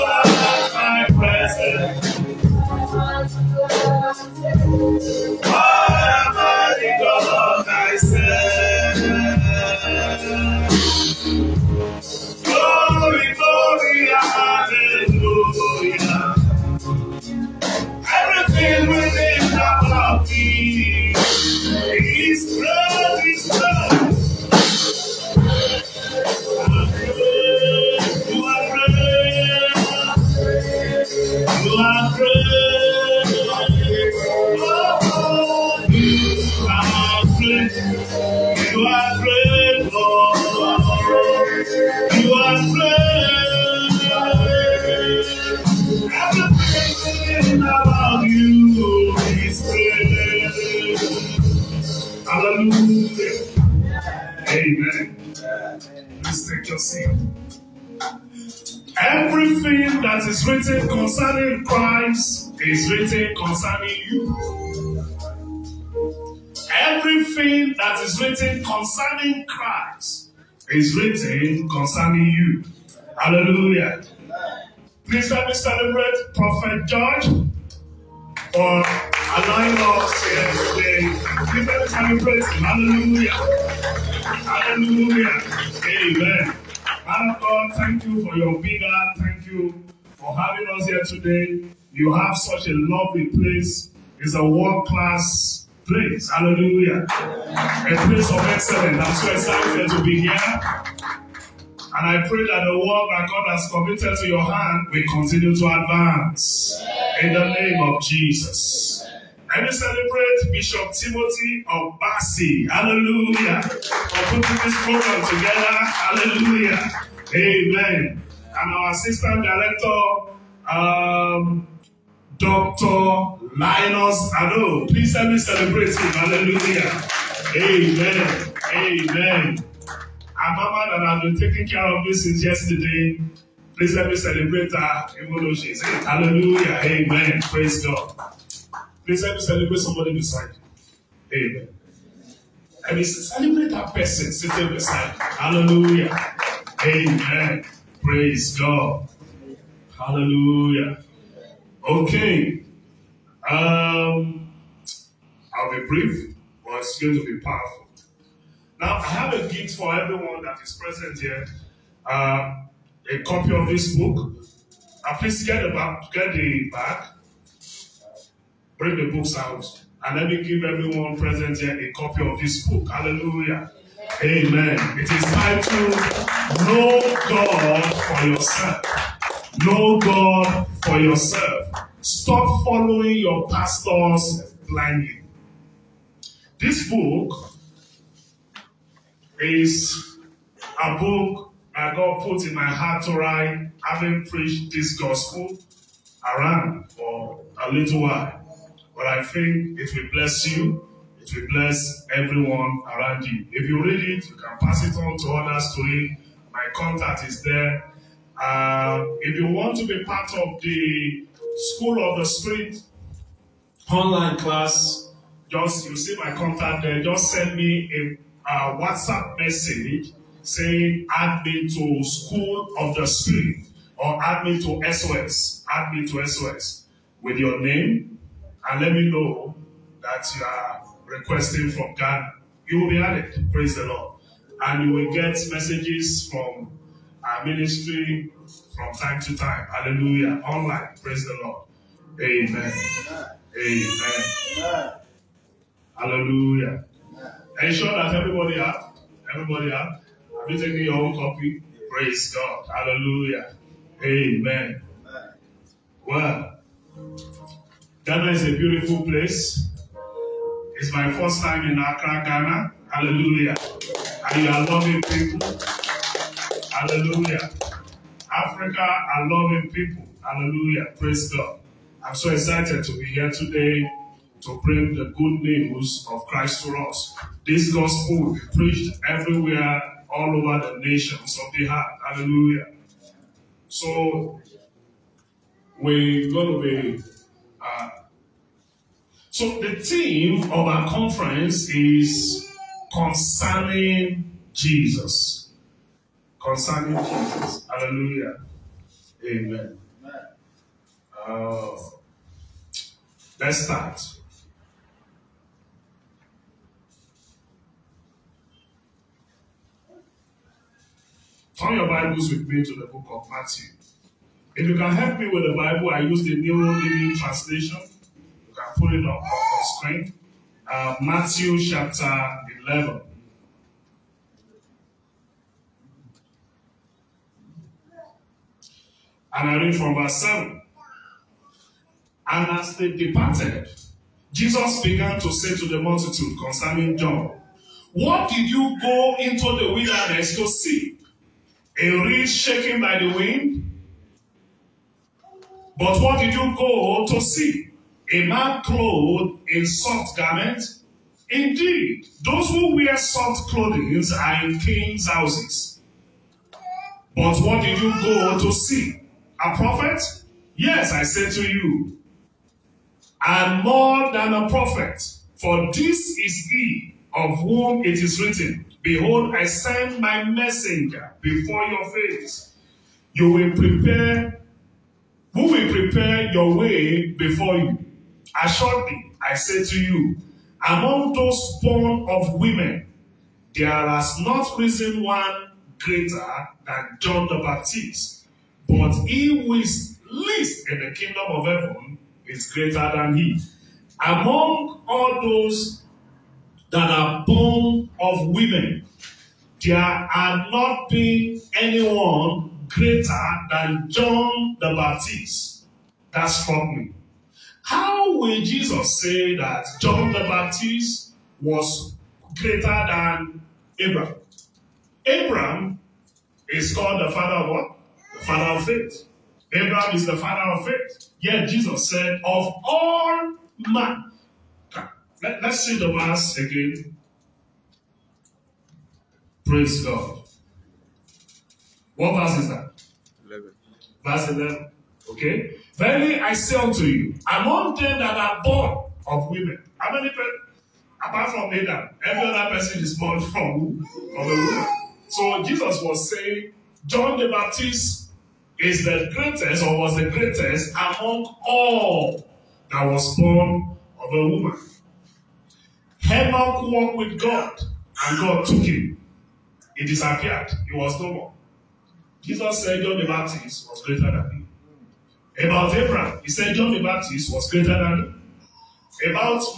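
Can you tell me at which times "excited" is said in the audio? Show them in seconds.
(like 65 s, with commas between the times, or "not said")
99 s, 272 s.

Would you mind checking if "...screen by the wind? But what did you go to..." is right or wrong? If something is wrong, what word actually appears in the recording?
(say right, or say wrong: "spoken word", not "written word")
wrong: "shaken", not "screen".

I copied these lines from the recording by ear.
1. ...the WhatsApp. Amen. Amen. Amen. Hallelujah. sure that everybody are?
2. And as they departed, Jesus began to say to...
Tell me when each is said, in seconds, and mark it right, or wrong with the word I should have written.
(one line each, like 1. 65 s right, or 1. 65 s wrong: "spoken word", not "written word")
1. 241 s wrong: "Lord", not "WhatsApp"
2. 332 s right.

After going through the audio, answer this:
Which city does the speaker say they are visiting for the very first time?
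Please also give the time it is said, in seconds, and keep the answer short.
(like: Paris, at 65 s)
Accra, at 260 s.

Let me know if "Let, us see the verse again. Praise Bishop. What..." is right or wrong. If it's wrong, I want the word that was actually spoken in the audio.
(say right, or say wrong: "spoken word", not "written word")
wrong: "God", not "Bishop".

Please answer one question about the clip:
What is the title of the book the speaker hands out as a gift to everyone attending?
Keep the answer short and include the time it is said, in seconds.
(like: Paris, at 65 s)
Know God for Yourself, at 174 s.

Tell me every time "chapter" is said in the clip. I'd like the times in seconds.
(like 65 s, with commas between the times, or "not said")
321 s.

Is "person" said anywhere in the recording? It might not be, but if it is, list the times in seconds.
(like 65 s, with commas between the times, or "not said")
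143 s, 442 s.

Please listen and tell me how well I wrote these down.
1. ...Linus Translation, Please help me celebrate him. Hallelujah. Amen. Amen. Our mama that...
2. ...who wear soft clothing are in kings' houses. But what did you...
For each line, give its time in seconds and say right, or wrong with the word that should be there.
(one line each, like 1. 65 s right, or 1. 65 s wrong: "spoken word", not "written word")
1. 123 s wrong: "Ado", not "Translation"
2. 352 s right.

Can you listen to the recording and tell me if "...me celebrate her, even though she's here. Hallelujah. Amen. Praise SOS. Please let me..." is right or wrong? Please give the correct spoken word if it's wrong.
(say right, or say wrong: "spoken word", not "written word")
wrong: "God", not "SOS".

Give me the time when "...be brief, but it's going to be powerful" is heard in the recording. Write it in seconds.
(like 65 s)
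155 s.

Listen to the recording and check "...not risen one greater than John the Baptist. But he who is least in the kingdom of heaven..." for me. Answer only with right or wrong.
right.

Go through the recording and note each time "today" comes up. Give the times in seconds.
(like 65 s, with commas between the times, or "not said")
80 s, 91 s, 273 s.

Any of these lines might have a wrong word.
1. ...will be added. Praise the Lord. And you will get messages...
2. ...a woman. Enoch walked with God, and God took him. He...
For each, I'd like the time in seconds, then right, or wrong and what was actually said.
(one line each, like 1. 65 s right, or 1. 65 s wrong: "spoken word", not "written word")
1. 232 s right
2. 454 s right.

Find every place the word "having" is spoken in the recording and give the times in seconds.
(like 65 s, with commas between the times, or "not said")
90 s, 193 s.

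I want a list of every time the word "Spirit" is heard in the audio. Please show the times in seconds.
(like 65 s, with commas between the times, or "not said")
212 s, 223 s.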